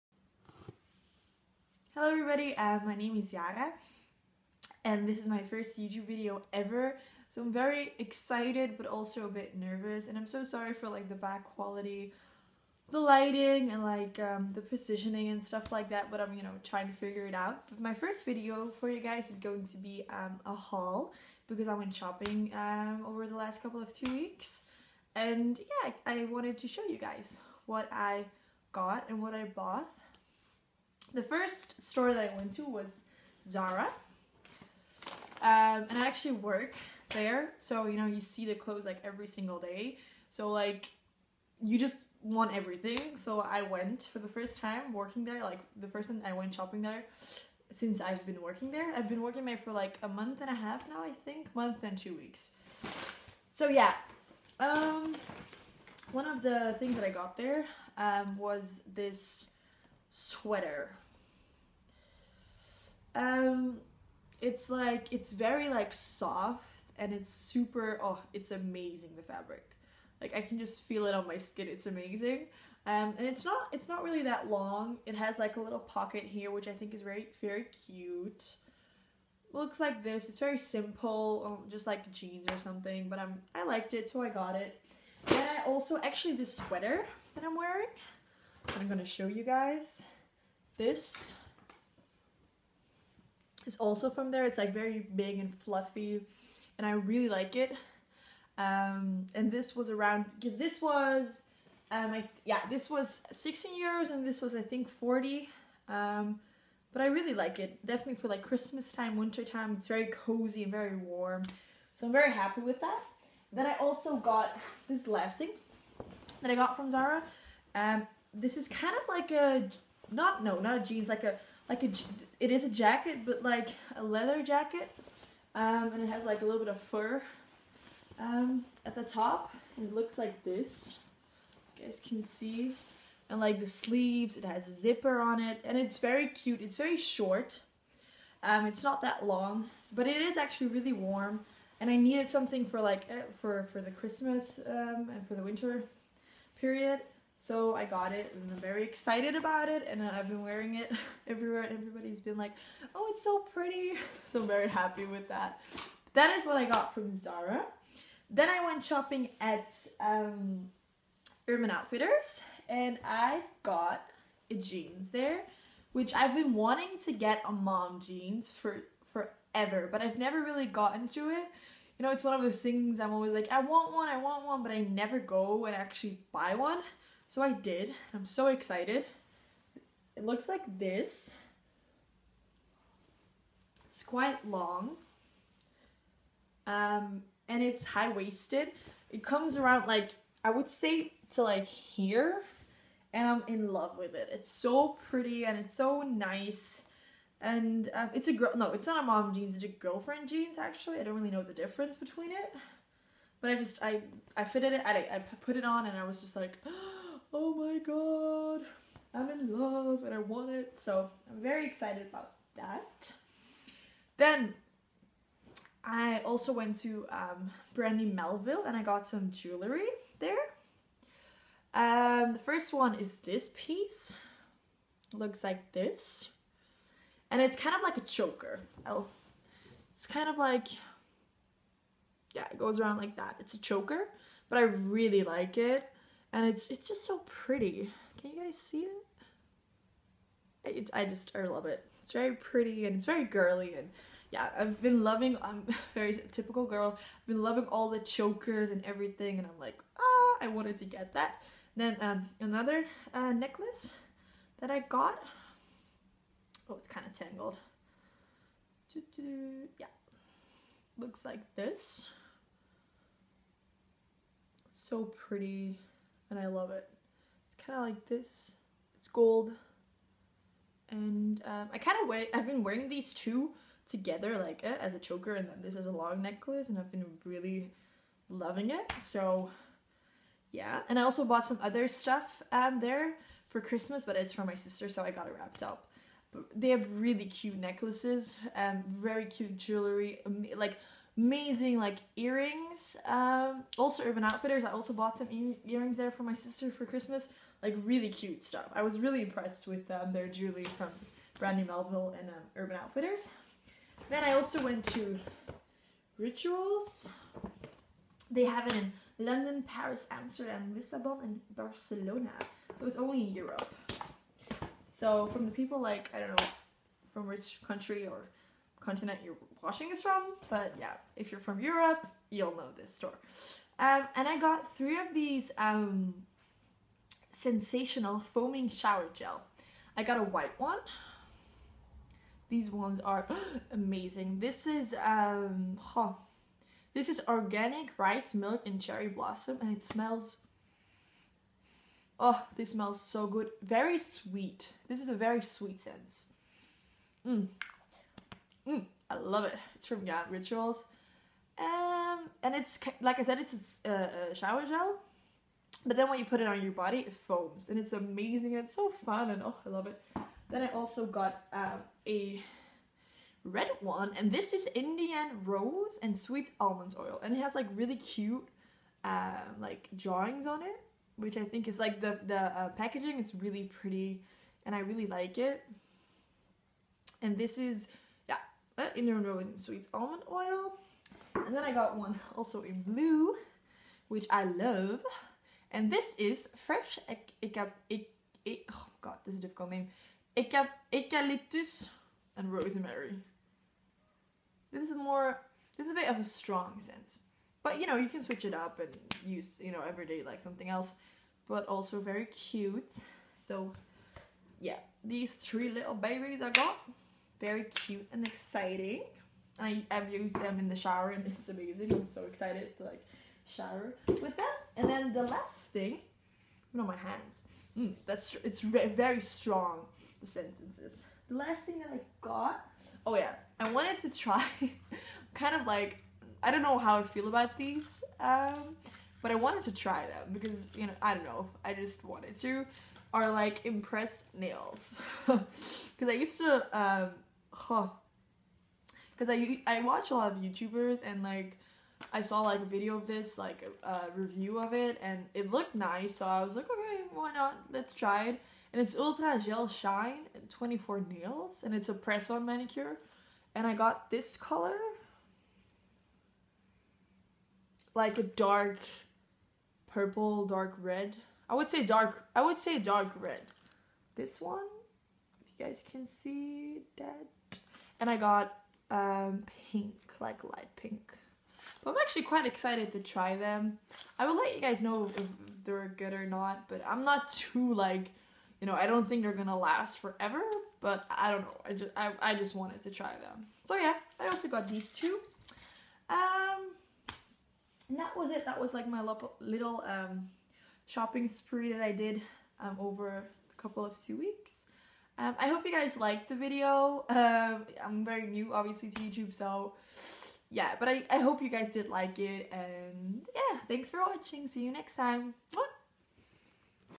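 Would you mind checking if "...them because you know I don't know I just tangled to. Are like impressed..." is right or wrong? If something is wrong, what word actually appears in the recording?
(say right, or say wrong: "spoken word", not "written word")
wrong: "wanted", not "tangled".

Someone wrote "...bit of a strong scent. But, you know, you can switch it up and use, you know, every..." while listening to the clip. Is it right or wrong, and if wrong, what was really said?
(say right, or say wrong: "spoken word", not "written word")
right.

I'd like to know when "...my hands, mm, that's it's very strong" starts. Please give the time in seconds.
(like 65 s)
416 s.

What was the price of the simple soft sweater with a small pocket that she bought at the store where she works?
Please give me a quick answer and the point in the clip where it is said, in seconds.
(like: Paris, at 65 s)
16 euros, at 103 s.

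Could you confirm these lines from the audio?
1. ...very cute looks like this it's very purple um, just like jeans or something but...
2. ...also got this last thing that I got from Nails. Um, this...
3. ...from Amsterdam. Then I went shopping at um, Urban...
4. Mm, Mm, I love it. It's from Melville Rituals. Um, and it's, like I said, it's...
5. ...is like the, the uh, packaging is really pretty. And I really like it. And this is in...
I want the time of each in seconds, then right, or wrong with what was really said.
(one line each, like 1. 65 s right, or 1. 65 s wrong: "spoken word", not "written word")
1. 77 s wrong: "simple", not "purple"
2. 113 s wrong: "Zara", not "Nails"
3. 156 s wrong: "Zara", not "Amsterdam"
4. 347 s wrong: "Yarn", not "Melville"
5. 371 s right.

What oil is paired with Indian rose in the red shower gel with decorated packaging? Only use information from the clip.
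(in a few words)
sweet almonds oil.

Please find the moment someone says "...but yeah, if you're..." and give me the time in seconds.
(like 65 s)
320 s.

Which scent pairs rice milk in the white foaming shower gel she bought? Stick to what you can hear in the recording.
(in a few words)
cherry blossom.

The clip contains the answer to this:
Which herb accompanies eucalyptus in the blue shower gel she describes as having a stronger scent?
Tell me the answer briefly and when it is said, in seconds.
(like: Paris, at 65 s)
rosemary, at 392 s.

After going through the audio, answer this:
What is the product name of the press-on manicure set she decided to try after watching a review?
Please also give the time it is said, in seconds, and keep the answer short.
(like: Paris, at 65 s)
Ultra Gel Shine 24 Nails, at 448 s.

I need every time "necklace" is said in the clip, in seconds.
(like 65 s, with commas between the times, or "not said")
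253 s, 276 s, 287 s.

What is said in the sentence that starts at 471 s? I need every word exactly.
But I'm actually quite excited to try them.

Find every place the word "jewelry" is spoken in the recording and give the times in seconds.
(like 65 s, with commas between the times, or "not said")
219 s, 289 s, 300 s.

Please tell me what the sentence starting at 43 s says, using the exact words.
So, I went for the first time working there, like, the first time I went shopping there since I've been working there.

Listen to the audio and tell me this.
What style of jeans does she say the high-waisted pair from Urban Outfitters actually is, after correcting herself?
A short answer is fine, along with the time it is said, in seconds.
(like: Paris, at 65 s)
girlfriend jeans, at 199 s.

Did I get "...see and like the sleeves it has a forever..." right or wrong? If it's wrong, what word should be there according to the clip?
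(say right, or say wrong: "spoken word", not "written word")
wrong: "zipper", not "forever".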